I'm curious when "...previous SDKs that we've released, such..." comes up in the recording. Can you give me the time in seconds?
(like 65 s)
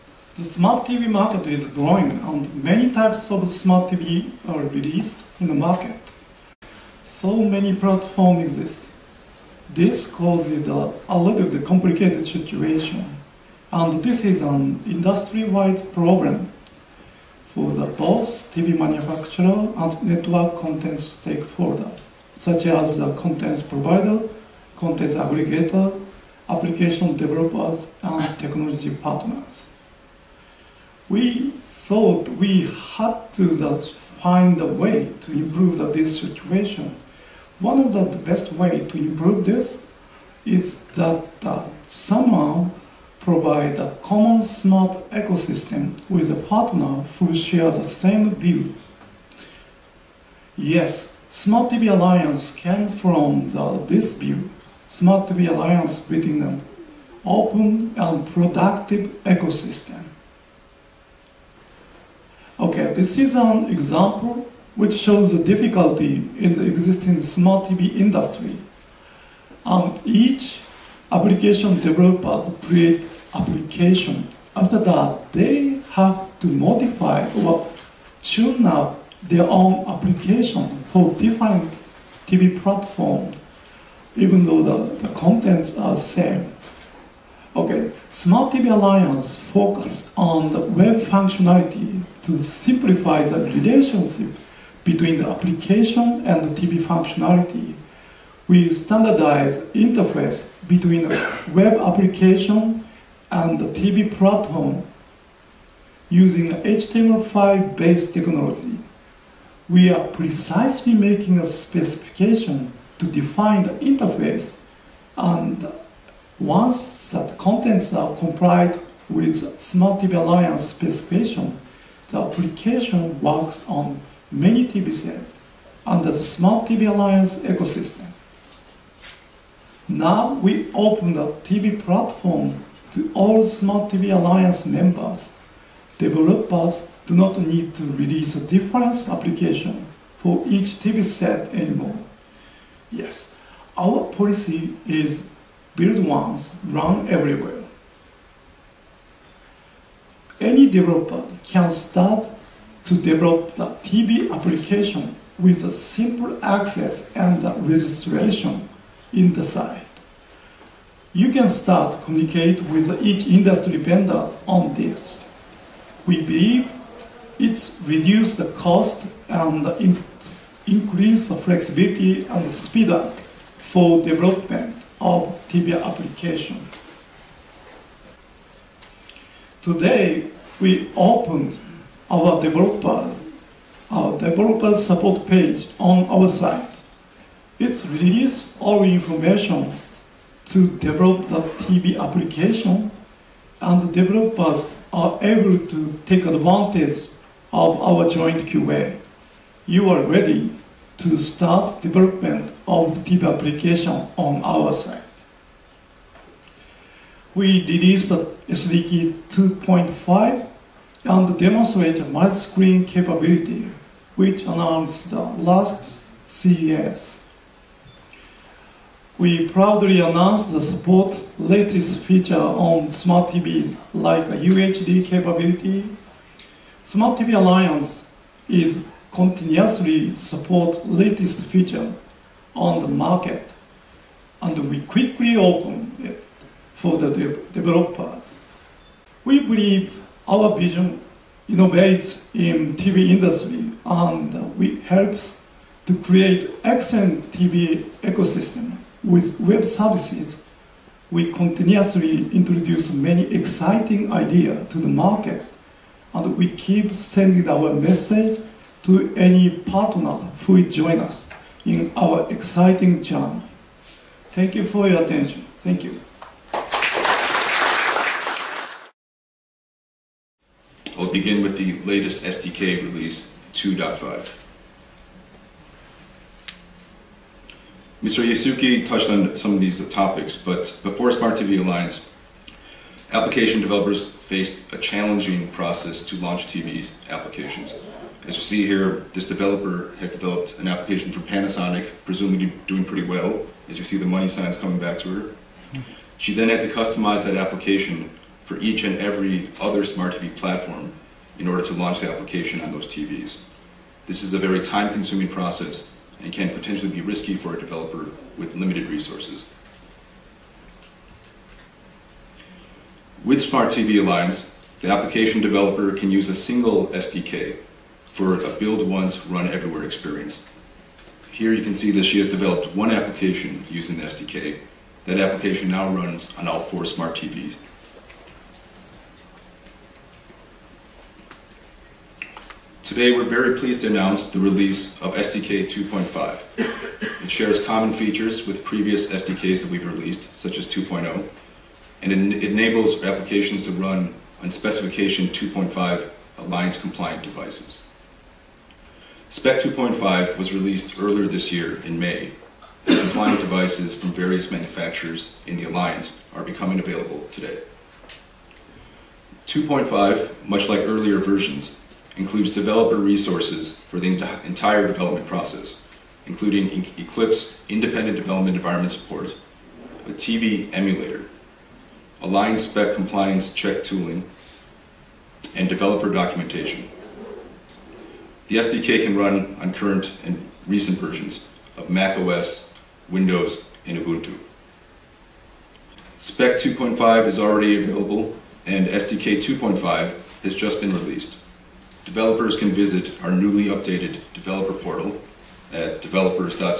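338 s.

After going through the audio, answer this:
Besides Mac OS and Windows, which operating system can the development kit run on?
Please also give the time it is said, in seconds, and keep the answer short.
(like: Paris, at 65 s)
Ubuntu, at 383 s.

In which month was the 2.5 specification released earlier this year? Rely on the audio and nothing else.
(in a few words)
May.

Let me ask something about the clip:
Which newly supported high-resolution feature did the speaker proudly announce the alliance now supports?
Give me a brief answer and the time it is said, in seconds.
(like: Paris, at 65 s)
UHD, at 224 s.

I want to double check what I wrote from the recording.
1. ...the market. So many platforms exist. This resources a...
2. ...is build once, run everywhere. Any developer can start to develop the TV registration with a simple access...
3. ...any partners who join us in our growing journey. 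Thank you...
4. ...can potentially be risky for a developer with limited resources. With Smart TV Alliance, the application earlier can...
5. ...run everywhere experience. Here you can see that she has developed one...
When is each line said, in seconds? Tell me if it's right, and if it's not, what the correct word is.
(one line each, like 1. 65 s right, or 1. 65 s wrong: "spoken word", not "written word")
1. 5 s wrong: "causes", not "resources"
2. 144 s wrong: "application", not "registration"
3. 259 s wrong: "exciting", not "growing"
4. 306 s wrong: "developer", not "earlier"
5. 319 s right.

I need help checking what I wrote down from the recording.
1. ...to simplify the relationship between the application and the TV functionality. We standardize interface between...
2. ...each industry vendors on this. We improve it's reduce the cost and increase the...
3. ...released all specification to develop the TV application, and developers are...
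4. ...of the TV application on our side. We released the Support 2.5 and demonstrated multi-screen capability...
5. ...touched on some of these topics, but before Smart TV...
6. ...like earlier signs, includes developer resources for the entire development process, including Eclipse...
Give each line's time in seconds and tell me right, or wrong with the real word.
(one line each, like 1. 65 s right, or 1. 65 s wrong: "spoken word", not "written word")
1. 92 s right
2. 163 s wrong: "believe", not "improve"
3. 187 s wrong: "information", not "specification"
4. 202 s wrong: "SDK", not "Support"
5. 278 s right
6. 360 s wrong: "versions", not "signs".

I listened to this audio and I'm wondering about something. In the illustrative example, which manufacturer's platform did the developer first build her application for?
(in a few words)
Panasonic.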